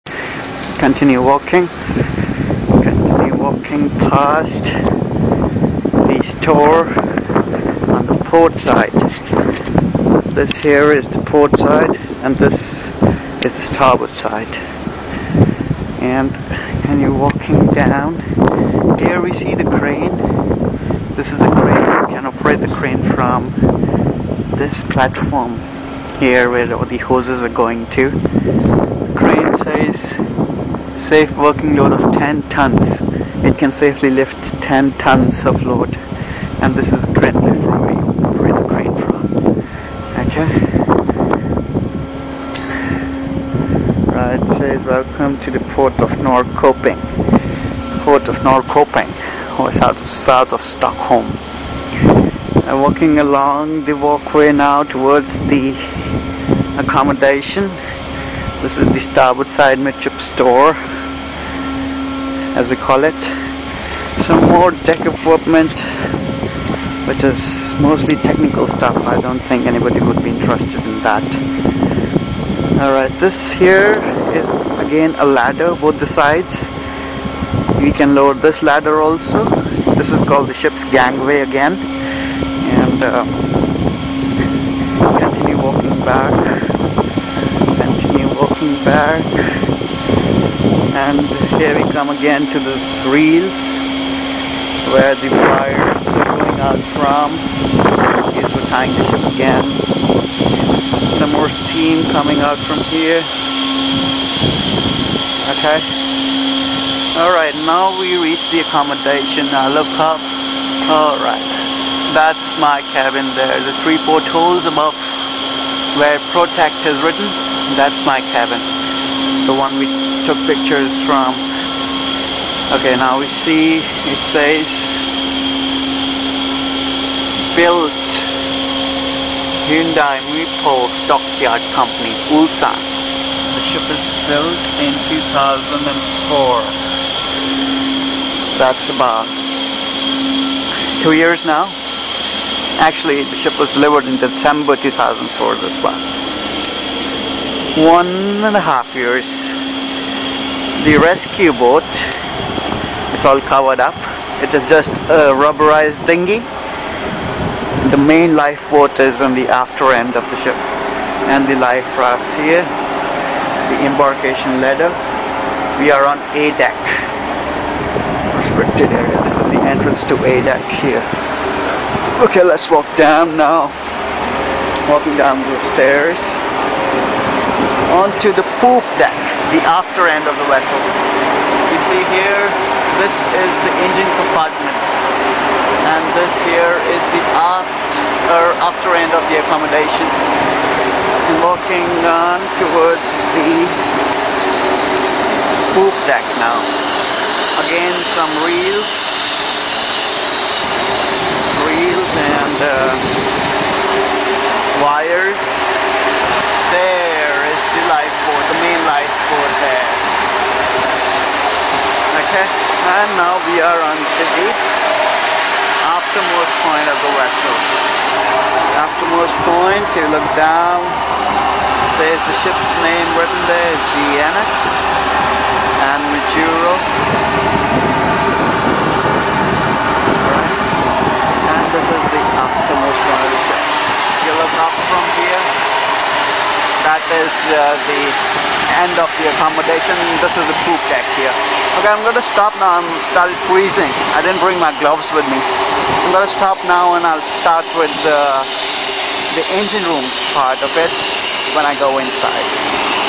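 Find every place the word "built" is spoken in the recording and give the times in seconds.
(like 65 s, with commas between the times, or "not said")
127 s, 134 s.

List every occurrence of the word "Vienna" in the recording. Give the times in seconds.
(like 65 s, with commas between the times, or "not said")
223 s.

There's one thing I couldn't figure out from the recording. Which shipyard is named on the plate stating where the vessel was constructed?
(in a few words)
Hyundai Mipo Dockyard.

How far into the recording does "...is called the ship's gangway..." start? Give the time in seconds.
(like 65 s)
80 s.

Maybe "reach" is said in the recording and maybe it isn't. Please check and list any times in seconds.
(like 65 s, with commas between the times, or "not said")
108 s.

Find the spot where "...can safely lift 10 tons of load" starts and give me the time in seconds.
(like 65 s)
33 s.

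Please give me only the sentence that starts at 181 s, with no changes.
You see here, this is the engine compartment and this here is the after, er, after end of the accommodation.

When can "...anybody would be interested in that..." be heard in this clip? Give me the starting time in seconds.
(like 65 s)
69 s.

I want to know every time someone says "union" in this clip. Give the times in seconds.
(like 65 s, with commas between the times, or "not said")
not said.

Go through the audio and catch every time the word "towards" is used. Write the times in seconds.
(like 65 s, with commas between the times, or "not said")
54 s, 192 s.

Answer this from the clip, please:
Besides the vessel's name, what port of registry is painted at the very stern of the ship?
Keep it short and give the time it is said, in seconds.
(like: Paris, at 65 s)
Majuro, at 226 s.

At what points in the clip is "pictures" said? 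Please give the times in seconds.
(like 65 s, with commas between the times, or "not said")
120 s.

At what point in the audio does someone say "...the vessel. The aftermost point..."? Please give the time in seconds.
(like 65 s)
216 s.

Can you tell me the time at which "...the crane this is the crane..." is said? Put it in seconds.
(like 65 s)
19 s.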